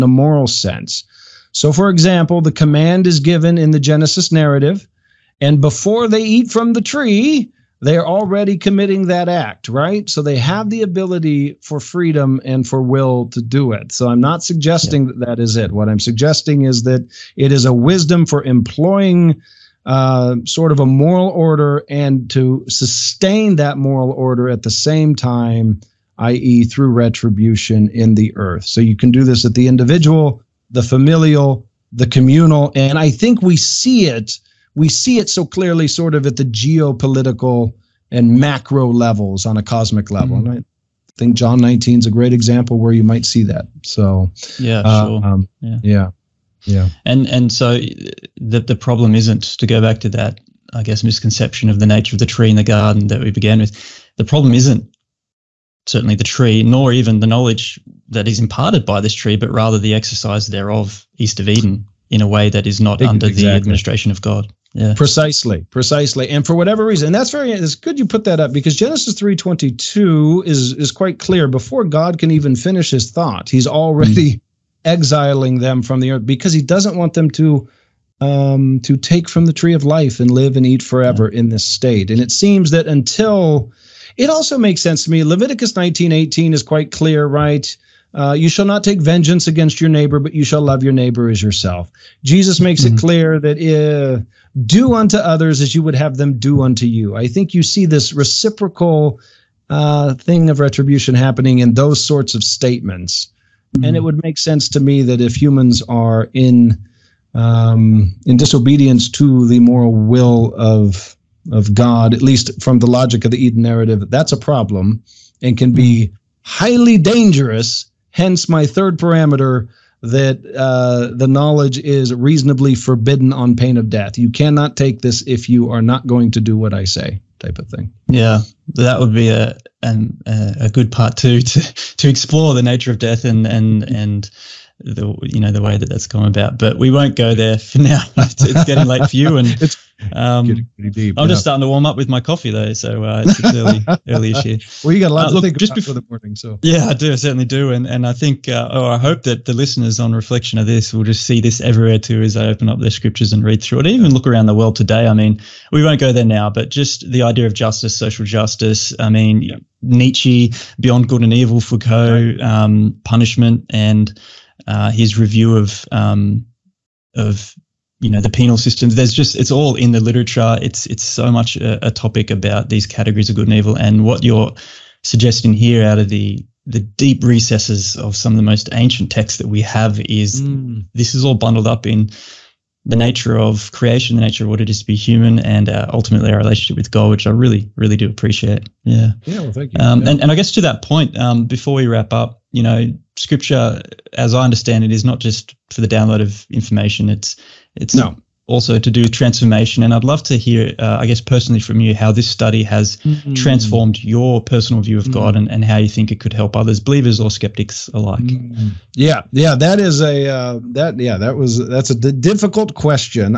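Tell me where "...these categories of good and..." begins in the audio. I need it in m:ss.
2:52.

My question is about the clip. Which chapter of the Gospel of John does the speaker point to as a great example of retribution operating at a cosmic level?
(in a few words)
John 19.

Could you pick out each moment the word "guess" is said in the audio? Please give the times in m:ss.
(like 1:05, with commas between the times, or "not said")
0:50, 3:10, 3:21.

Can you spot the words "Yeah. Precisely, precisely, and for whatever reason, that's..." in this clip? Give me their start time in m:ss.
1:04.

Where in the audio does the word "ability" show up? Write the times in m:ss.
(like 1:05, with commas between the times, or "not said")
0:10.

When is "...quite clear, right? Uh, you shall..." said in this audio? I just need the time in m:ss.
1:26.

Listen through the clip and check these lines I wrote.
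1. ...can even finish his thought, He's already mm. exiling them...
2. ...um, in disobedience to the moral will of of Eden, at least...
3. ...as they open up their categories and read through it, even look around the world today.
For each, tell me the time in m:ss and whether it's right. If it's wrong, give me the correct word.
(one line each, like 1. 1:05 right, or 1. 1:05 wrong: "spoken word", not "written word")
1. 1:12 right
2. 1:47 wrong: "God", not "Eden"
3. 2:32 wrong: "scriptures", not "categories".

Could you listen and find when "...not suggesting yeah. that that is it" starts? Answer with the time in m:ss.
0:14.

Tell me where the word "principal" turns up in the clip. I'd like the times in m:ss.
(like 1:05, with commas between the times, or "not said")
not said.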